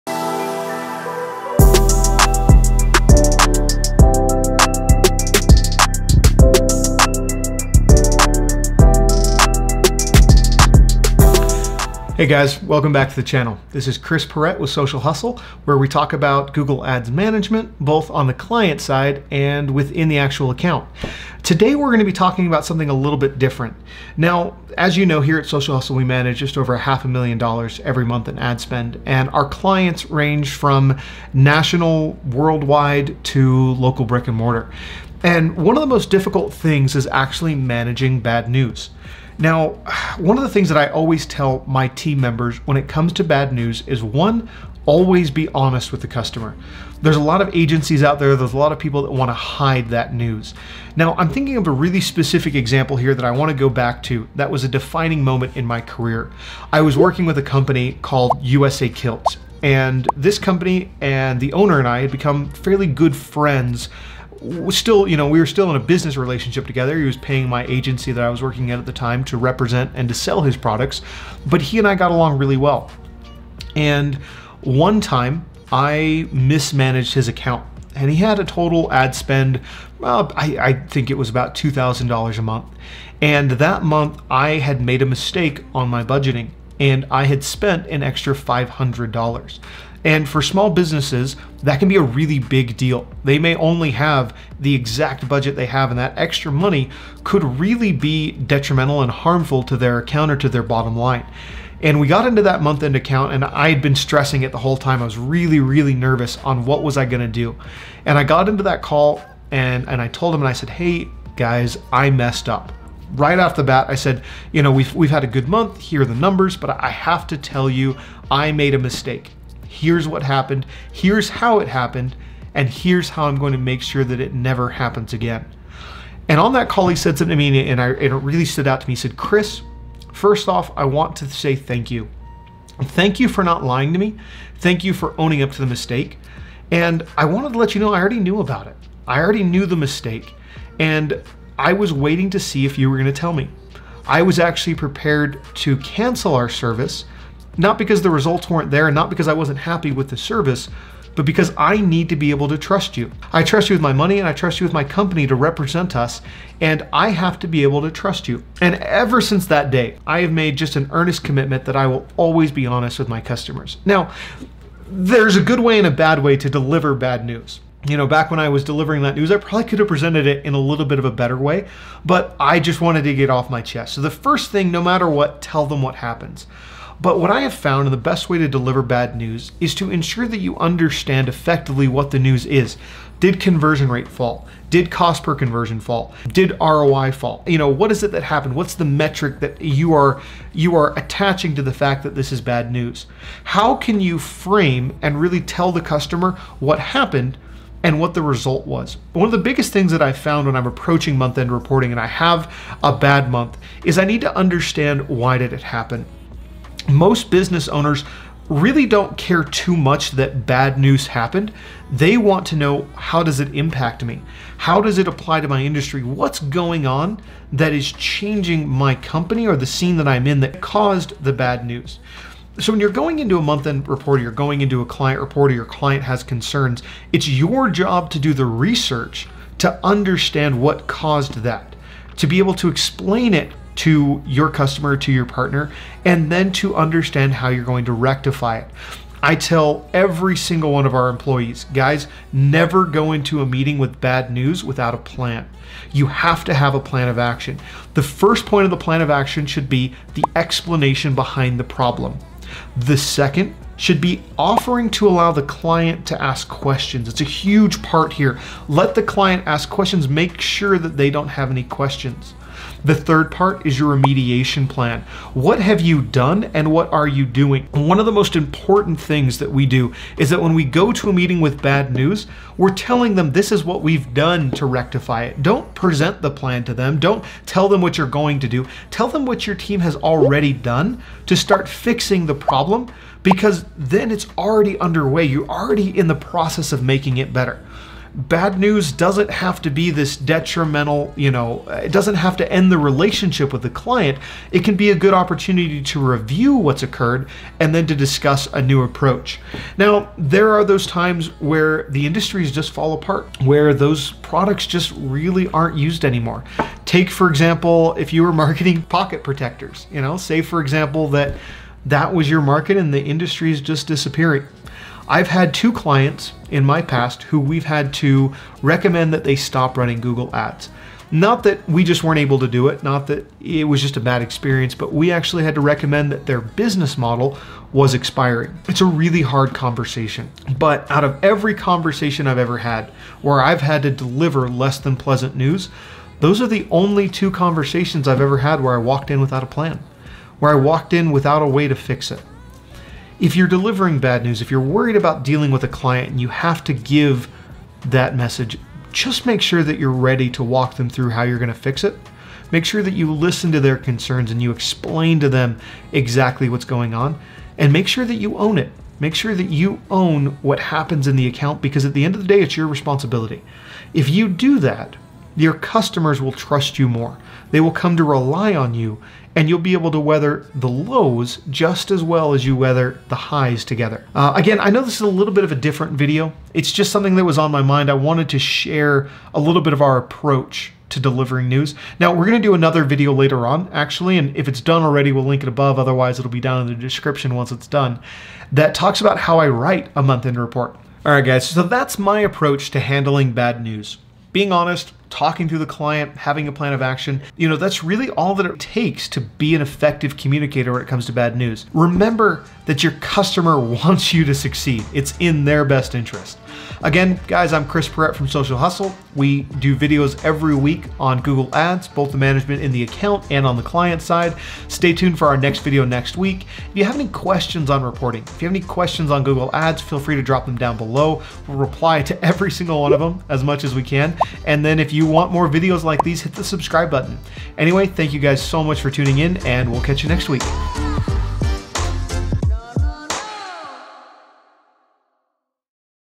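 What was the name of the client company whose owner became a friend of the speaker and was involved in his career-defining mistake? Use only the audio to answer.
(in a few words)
USA Kilt.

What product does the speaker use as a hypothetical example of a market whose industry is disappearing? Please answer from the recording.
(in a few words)
pocket protectors.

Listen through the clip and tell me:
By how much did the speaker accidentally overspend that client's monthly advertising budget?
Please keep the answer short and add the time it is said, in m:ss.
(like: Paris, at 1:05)
$500, at 1:28.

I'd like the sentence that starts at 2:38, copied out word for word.
And ever since that day, I have made just an earnest commitment that I will always be honest with my customers.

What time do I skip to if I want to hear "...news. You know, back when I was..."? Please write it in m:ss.
2:47.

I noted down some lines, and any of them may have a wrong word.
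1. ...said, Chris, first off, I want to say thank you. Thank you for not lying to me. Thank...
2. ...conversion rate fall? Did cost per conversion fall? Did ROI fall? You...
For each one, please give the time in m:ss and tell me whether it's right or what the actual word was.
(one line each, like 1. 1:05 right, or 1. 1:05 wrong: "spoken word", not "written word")
1. 2:08 right
2. 3:03 right.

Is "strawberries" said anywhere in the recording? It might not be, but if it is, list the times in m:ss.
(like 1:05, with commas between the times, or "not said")
not said.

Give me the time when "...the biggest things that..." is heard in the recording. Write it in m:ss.
3:19.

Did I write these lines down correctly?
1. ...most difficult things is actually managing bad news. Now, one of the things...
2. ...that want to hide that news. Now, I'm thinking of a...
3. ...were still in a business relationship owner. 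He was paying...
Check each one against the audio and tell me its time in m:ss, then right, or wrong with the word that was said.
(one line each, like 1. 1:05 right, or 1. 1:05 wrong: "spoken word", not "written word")
1. 0:35 right
2. 0:49 right
3. 1:05 wrong: "together", not "owner".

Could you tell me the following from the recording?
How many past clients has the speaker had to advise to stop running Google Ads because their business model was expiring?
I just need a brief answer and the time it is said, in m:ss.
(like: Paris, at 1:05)
2, at 5:15.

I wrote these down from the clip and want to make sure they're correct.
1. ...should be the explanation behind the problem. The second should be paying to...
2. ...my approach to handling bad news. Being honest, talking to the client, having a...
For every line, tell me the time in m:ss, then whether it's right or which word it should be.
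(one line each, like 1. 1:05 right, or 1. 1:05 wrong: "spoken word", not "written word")
1. 4:09 wrong: "offering", not "paying"
2. 6:31 right.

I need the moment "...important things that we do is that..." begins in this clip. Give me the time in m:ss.
4:28.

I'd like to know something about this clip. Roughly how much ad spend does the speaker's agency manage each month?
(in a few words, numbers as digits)
half a million dollars.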